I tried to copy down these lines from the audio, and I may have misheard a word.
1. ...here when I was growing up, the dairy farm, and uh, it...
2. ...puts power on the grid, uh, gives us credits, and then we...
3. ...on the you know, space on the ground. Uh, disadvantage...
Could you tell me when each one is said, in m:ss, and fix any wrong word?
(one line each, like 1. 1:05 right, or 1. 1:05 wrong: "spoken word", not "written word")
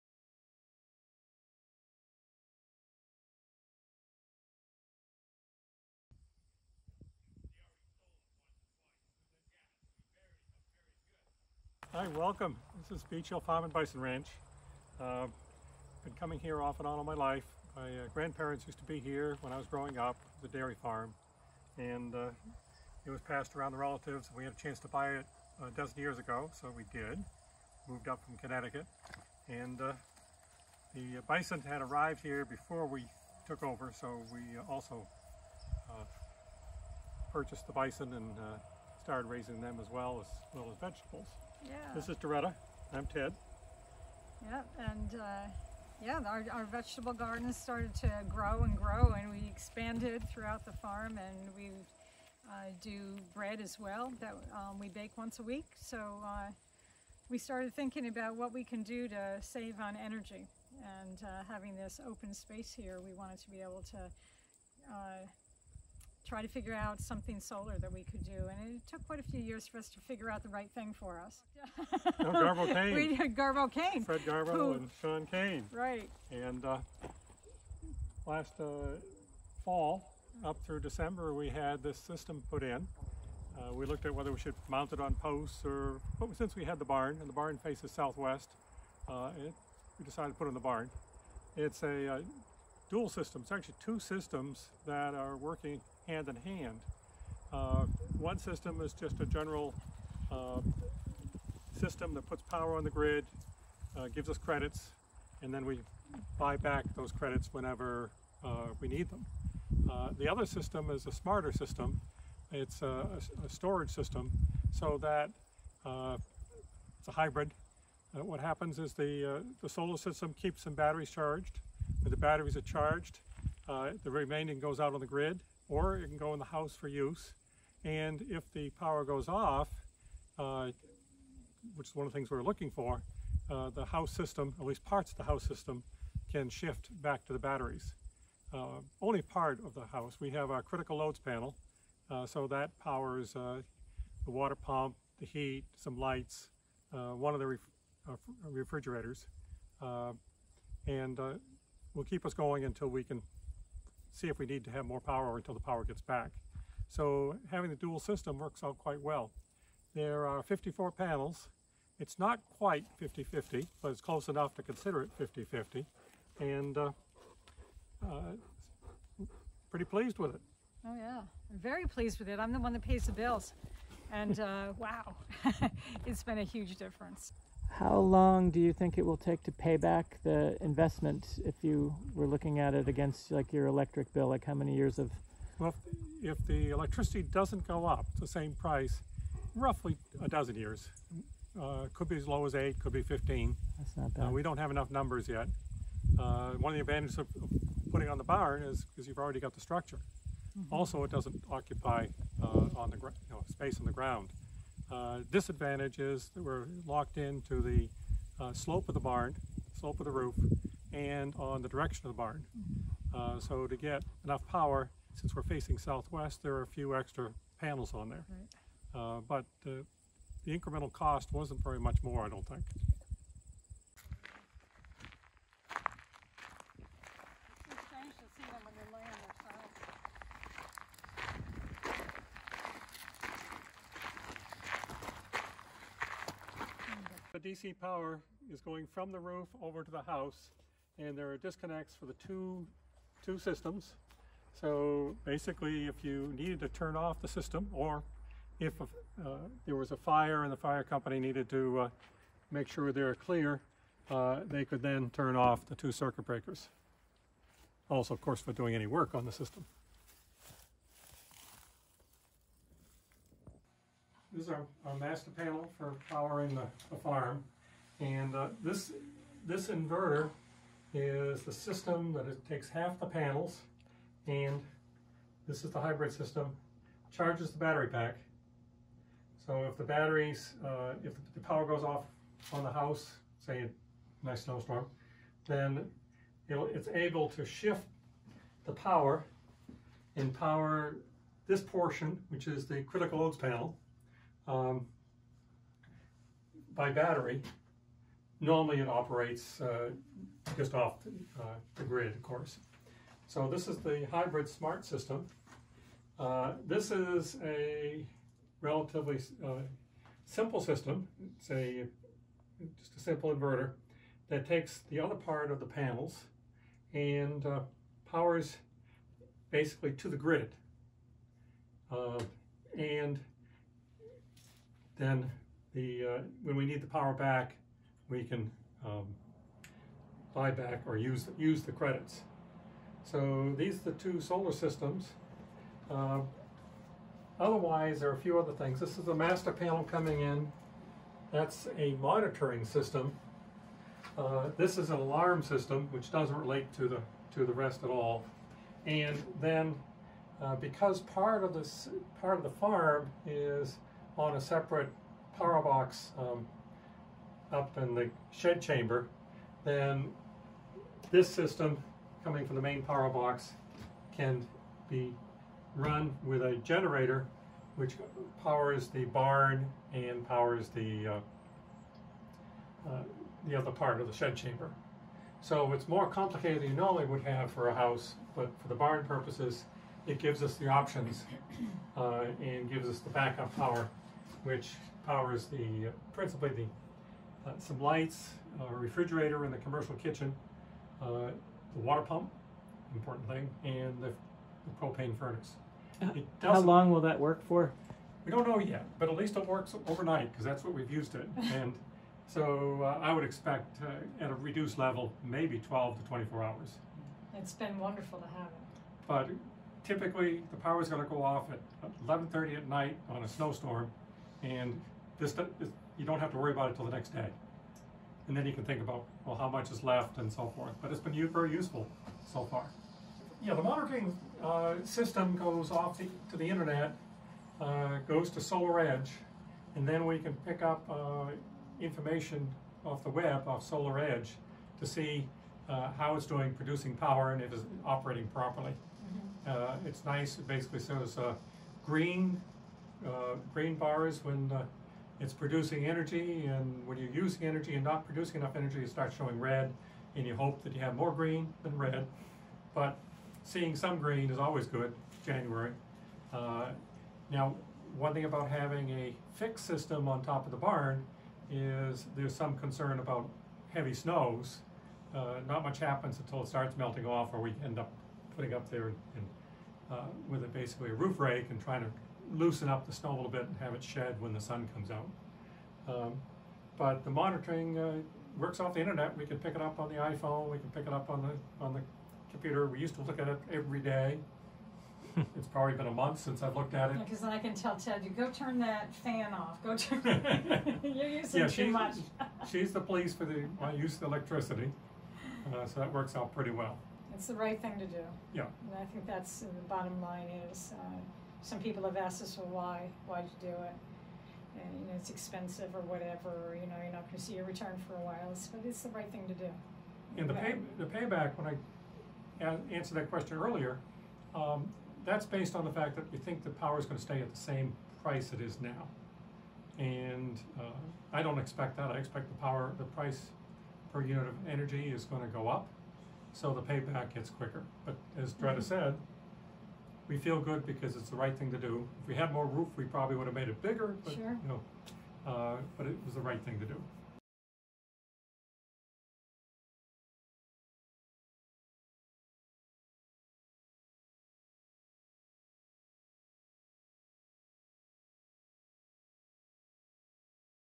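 1. 0:18 right
2. 1:42 right
3. 3:22 right.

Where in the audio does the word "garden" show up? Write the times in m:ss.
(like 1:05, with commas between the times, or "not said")
0:47.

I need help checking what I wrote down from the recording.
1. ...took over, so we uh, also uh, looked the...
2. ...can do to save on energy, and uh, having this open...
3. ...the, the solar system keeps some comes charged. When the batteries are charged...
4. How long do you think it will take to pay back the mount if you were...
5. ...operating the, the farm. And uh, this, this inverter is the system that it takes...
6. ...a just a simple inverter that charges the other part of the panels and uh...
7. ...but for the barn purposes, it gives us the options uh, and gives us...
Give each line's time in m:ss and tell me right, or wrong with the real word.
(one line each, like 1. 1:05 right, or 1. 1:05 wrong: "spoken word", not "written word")
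1. 0:33 wrong: "purchased", not "looked"
2. 0:58 right
3. 1:58 wrong: "batteries", not "comes"
4. 2:57 wrong: "investment", not "mount"
5. 4:26 wrong: "powering", not "operating"
6. 5:11 wrong: "takes", not "charges"
7. 6:18 right.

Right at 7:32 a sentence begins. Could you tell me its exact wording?
But seeing some green is always good, January.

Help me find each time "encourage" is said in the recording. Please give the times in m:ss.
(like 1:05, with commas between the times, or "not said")
not said.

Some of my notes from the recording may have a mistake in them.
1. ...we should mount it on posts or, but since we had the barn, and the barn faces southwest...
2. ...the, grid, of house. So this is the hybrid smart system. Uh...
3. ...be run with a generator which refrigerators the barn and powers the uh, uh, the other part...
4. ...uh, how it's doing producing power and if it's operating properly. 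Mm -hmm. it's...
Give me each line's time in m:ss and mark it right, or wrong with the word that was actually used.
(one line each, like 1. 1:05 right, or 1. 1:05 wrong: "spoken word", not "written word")
1. 1:24 right
2. 5:01 wrong: "course", not "house"
3. 6:04 wrong: "powers", not "refrigerators"
4. 7:15 right.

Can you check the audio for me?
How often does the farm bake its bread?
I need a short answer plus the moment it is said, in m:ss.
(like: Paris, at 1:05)
once a week, at 0:55.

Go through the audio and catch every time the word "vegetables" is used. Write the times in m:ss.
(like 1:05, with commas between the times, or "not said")
0:40, 0:46.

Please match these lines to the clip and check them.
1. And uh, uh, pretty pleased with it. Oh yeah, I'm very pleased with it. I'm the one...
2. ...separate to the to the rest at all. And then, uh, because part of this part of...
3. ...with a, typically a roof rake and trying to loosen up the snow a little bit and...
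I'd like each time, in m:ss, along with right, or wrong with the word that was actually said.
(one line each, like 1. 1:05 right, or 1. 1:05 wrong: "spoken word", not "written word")
1. 2:46 right
2. 5:46 wrong: "relate", not "separate"
3. 7:50 wrong: "basically", not "typically".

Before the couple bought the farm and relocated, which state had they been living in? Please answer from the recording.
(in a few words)
Connecticut.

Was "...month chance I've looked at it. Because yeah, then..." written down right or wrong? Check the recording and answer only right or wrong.
wrong.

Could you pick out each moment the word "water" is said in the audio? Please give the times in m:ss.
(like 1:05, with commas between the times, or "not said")
2:24, 6:31.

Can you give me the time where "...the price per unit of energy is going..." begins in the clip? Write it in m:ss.
8:42.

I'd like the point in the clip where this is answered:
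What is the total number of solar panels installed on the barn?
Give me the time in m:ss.
2:40.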